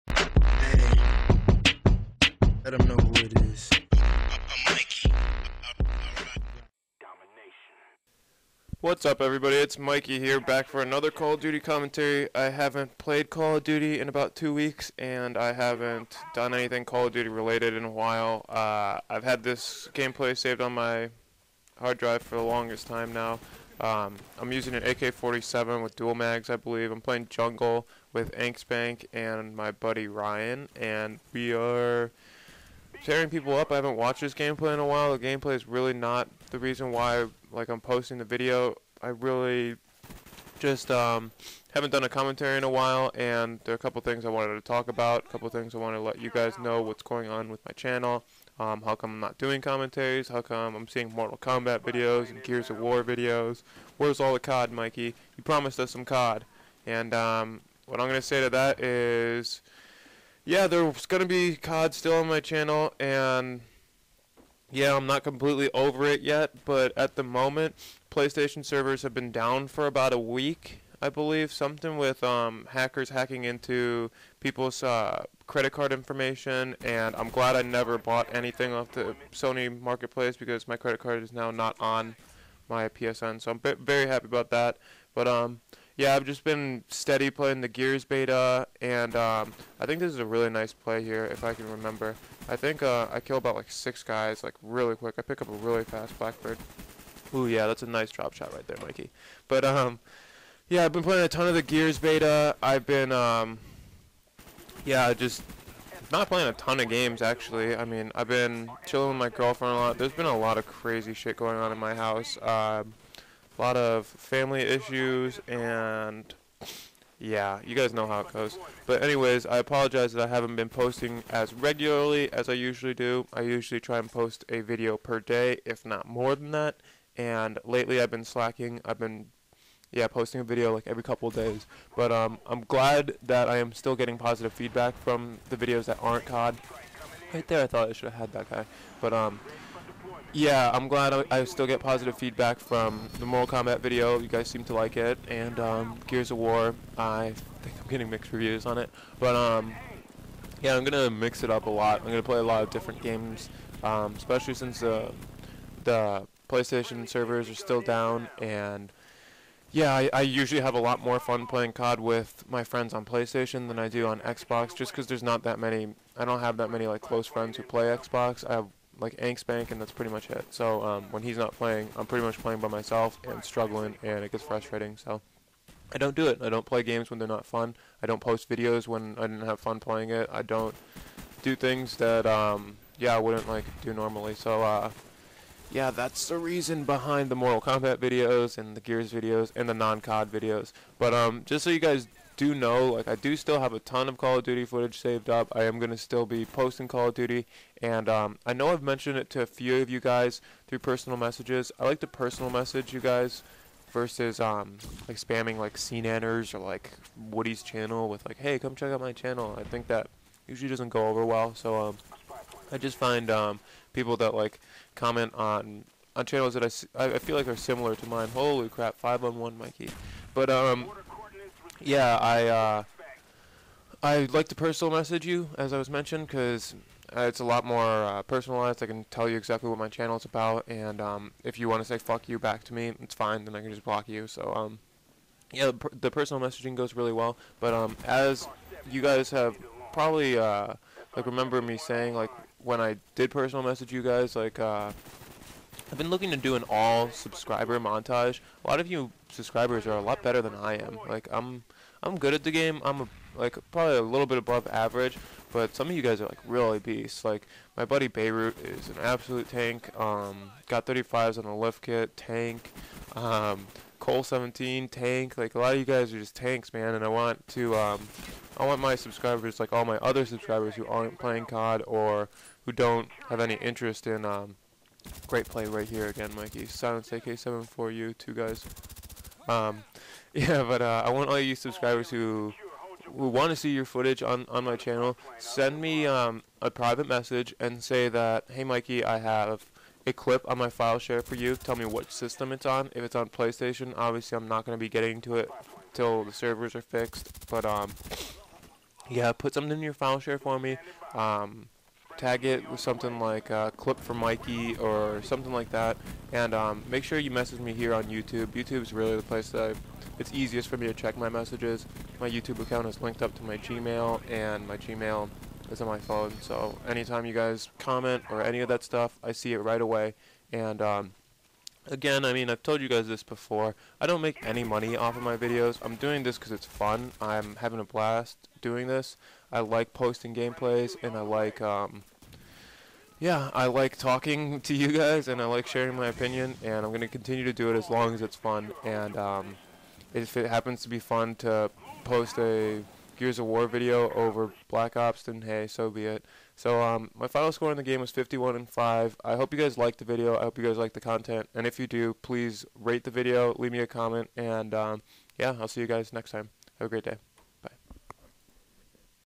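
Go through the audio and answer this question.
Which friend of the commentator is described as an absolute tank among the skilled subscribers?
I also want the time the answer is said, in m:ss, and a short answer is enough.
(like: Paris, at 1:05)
Beirut, at 4:18.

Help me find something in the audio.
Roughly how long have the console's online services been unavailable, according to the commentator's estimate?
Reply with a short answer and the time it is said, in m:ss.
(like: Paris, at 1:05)
about a week, at 1:09.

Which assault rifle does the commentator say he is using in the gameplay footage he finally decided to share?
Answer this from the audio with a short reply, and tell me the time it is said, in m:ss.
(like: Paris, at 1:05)
AK-47, at 0:24.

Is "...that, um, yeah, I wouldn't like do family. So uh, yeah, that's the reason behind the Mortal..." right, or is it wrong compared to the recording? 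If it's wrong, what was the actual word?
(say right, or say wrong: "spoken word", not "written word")
wrong: "normally", not "family".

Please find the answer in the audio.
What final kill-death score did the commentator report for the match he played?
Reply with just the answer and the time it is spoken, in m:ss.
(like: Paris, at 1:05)
51 and 5, at 5:48.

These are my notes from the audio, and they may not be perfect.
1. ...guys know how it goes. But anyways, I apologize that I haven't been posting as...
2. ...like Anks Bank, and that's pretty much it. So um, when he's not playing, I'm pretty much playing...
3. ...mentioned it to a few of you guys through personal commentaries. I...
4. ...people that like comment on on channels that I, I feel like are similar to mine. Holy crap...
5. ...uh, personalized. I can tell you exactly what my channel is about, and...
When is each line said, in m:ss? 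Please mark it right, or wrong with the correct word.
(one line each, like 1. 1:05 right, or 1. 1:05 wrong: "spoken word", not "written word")
1. 1:57 right
2. 2:49 right
3. 3:18 wrong: "messages", not "commentaries"
4. 3:33 right
5. 3:47 right.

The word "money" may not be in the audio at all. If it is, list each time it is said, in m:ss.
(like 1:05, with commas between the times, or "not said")
5:24.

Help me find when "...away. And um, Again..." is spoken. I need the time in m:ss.
5:19.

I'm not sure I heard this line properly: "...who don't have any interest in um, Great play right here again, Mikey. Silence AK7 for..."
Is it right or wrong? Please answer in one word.
right.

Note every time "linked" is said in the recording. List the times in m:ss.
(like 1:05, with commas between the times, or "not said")
5:13.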